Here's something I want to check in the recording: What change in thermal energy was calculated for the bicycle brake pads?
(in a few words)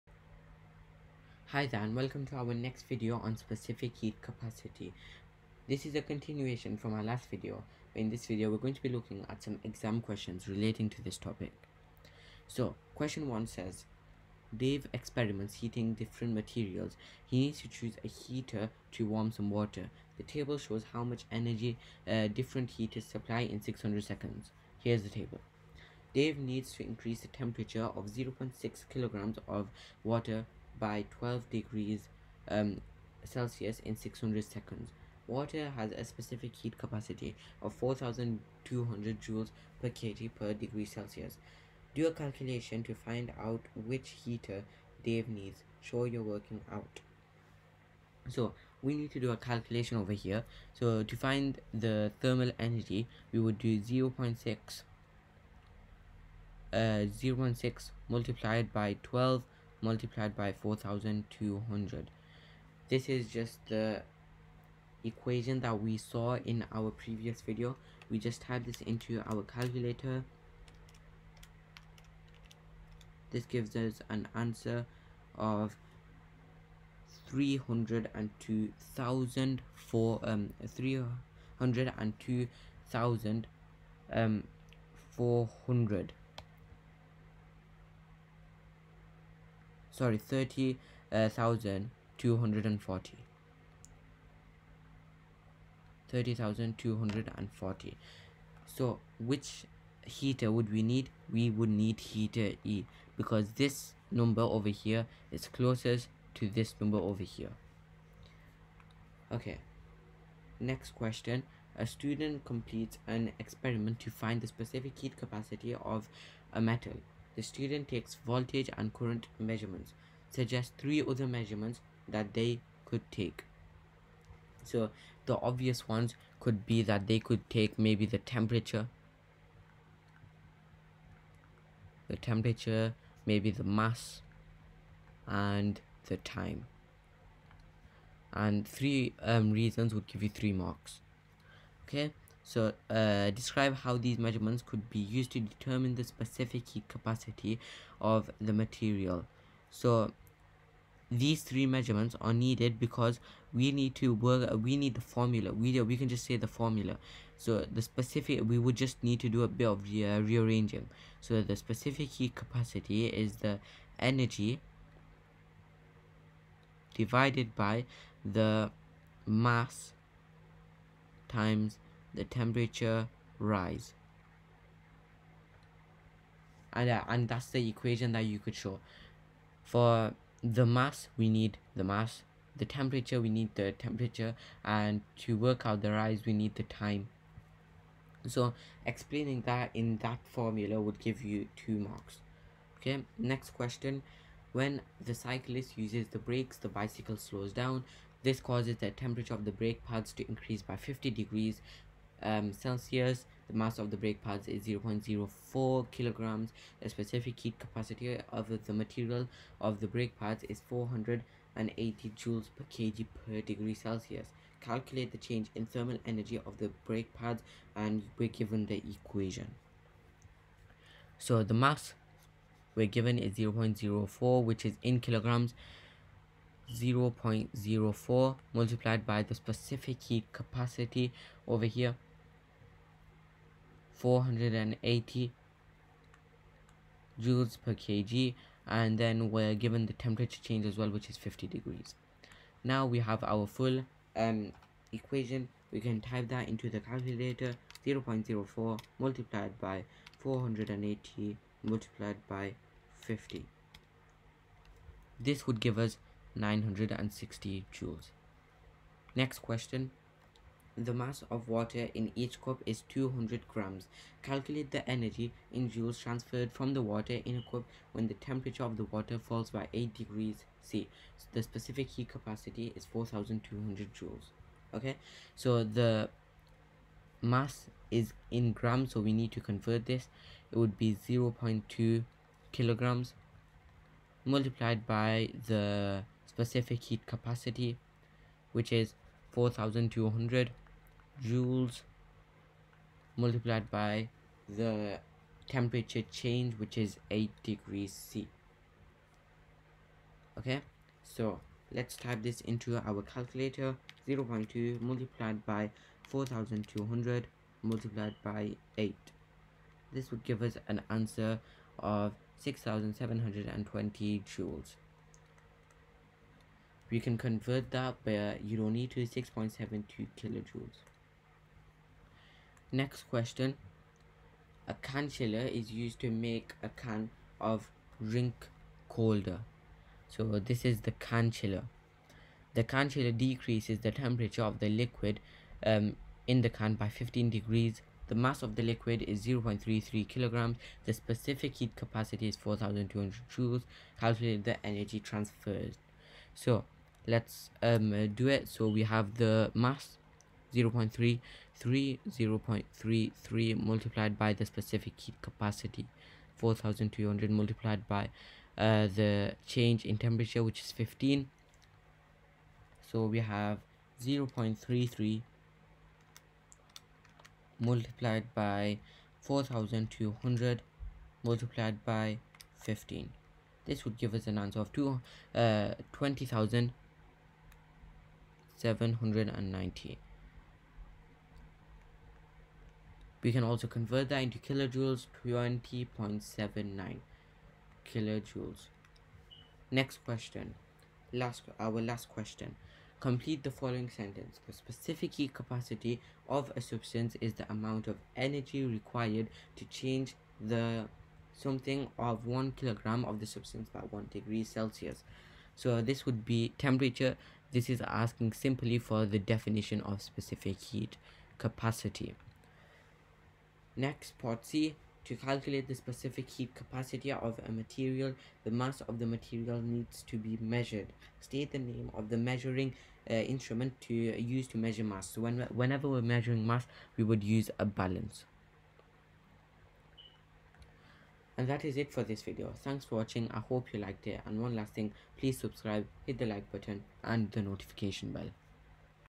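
960 joules.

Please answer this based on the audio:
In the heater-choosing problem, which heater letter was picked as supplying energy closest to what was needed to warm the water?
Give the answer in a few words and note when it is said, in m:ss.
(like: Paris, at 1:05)
Heater E, at 1:41.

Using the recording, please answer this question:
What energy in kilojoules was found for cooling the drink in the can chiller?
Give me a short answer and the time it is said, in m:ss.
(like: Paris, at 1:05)
20.79 kilojoules, at 6:25.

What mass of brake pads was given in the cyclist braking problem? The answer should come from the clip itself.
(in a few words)
0.04 kilograms.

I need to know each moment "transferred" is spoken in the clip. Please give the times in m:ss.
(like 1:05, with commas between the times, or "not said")
4:26, 5:44.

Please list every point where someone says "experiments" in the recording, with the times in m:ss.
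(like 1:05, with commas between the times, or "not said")
0:14, 1:53.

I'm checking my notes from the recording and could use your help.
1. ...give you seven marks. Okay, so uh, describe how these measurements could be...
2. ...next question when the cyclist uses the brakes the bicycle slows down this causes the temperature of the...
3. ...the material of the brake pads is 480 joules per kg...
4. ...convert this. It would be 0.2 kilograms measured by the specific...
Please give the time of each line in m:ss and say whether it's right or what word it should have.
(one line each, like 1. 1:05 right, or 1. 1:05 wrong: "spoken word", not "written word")
1. 2:20 wrong: "three", not "seven"
2. 3:13 right
3. 3:28 right
4. 4:39 wrong: "multiplied", not "measured".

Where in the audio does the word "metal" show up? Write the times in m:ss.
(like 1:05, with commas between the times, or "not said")
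1:56.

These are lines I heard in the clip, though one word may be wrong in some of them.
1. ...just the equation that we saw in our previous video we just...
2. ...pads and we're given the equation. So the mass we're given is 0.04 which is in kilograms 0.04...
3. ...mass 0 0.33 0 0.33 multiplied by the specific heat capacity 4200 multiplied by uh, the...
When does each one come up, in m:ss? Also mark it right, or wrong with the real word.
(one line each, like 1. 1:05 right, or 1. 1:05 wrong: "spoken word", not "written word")
1. 1:03 right
2. 3:37 right
3. 5:49 right.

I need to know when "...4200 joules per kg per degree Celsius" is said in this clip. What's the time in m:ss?
0:37.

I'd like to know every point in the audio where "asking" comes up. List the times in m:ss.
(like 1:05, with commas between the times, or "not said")
6:47.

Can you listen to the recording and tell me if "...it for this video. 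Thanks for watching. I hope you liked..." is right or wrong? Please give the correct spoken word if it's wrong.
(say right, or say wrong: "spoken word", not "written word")
right.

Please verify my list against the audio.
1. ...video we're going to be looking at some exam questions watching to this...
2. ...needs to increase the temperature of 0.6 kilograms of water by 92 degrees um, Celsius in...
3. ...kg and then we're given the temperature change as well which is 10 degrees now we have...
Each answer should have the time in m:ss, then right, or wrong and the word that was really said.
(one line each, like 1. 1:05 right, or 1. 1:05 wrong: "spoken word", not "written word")
1. 0:08 wrong: "relating", not "watching"
2. 0:26 wrong: "12", not "92"
3. 3:57 wrong: "50", not "10".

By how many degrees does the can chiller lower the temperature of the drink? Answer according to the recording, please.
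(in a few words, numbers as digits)
15 degrees.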